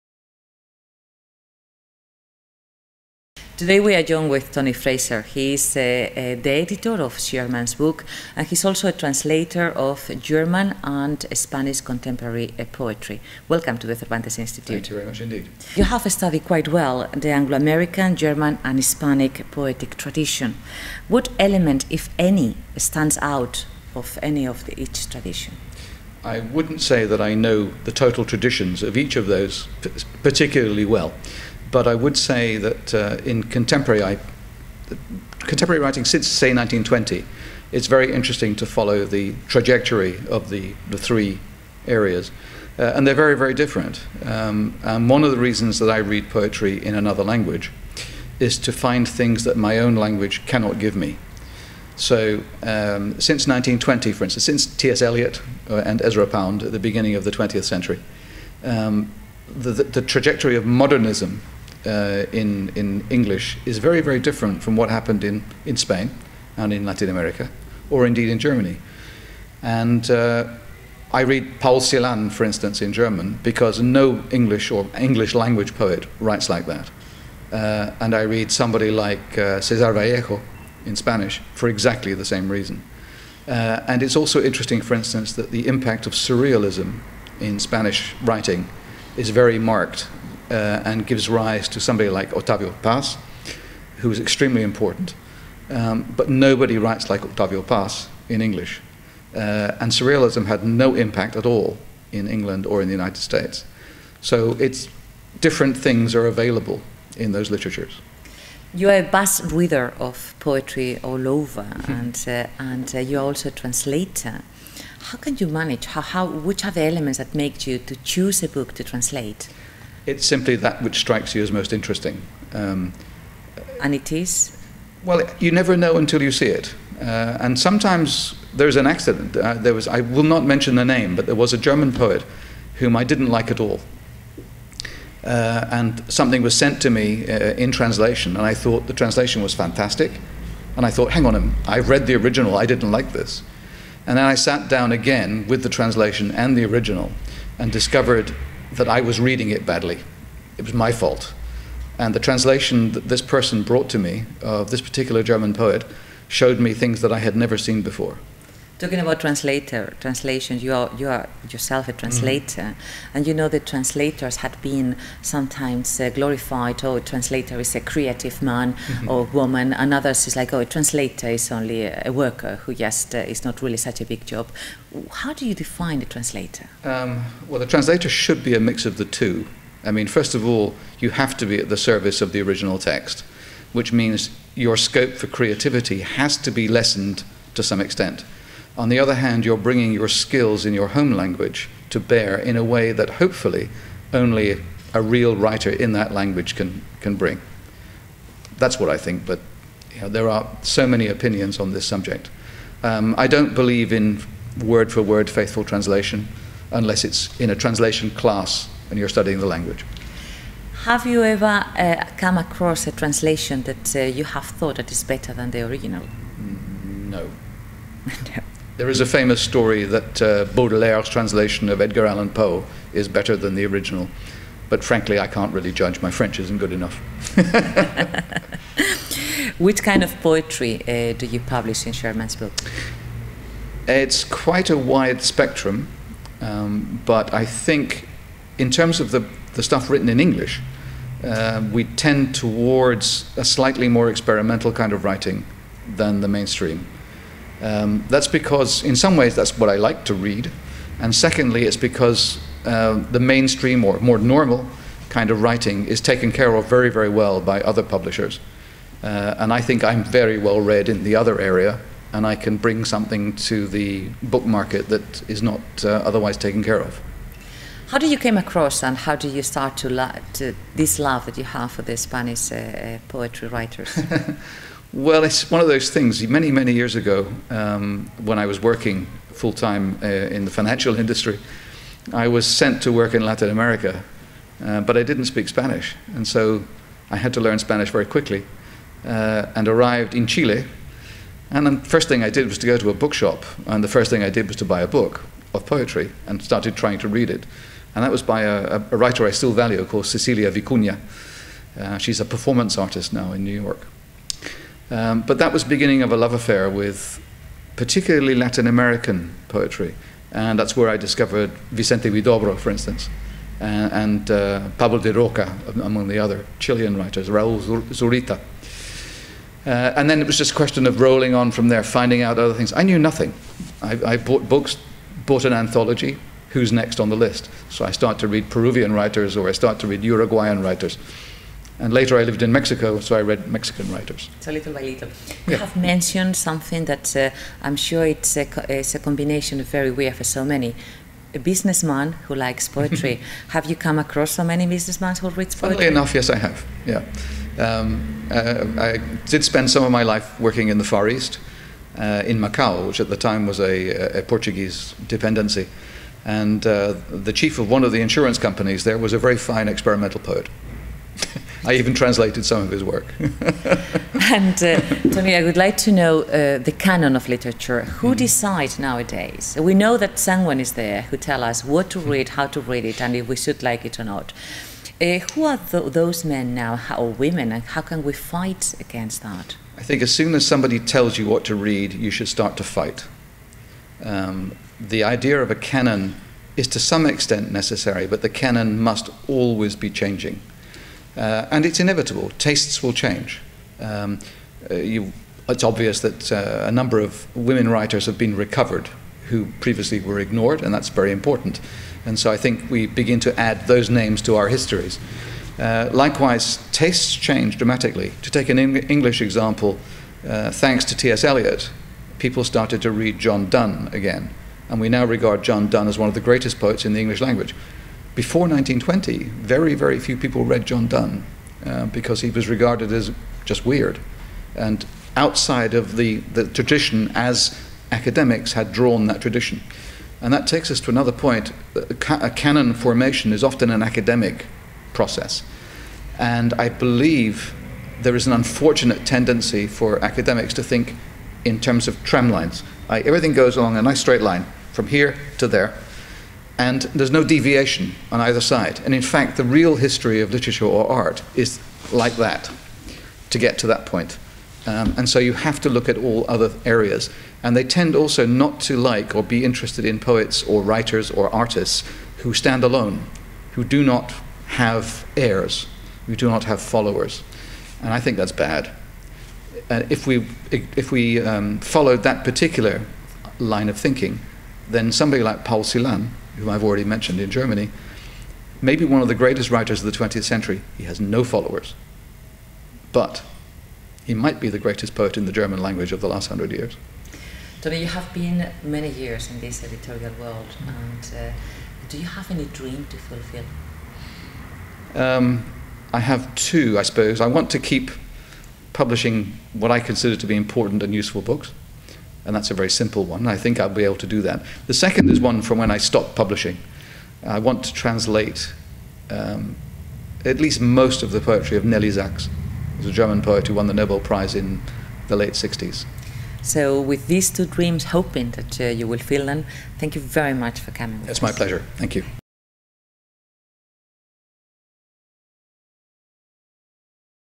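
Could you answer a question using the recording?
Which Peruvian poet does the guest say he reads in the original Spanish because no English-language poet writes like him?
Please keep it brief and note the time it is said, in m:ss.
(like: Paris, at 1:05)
Cesar Vallejo, at 1:19.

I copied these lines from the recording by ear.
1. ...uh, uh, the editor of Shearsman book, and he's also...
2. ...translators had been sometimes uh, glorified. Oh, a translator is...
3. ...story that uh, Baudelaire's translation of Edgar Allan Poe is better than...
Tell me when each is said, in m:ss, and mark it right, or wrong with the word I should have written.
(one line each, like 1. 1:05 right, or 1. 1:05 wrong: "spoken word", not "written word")
1. 0:05 right
2. 2:43 right
3. 3:39 right.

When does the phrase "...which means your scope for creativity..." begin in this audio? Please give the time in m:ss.
3:03.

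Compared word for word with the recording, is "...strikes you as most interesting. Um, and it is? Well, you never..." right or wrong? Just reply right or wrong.
right.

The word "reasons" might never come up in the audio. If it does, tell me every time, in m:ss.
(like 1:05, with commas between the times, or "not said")
0:45, 1:22.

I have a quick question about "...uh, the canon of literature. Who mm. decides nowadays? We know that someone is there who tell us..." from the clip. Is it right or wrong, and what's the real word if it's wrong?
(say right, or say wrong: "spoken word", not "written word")
right.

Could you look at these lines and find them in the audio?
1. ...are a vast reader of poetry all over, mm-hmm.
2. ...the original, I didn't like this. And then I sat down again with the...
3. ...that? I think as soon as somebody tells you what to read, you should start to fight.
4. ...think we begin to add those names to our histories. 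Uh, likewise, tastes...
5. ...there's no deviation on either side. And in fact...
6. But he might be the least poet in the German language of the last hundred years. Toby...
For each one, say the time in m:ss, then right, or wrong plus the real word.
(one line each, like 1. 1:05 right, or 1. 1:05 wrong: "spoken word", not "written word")
1. 1:48 right
2. 2:22 right
3. 6:19 right
4. 6:42 right
5. 7:26 right
6. 8:02 wrong: "greatest", not "least".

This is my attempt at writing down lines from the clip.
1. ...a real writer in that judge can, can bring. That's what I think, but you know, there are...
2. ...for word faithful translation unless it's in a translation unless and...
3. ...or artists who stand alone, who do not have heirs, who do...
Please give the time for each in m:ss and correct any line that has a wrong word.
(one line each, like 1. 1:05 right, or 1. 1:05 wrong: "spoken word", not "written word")
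1. 3:14 wrong: "language", not "judge"
2. 3:24 wrong: "class", not "unless"
3. 7:41 right.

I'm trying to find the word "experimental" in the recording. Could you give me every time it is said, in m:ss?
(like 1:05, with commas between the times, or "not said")
4:04, 5:59.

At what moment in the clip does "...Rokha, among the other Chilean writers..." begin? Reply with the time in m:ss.
5:15.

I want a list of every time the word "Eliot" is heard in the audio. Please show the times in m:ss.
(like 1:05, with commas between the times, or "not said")
0:55, 6:51.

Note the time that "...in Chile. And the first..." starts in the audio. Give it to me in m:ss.
4:50.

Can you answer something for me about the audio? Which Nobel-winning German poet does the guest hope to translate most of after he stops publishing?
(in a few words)
Nelly Sachs.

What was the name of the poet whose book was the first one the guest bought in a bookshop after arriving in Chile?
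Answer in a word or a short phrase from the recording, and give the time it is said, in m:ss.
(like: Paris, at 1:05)
Cecilia Vicuña, at 5:00.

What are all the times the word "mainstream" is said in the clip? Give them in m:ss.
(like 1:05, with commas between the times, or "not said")
4:06, 4:13.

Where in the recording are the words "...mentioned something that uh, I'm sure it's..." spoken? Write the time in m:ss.
5:35.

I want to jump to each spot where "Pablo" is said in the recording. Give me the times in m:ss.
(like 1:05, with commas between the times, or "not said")
5:14.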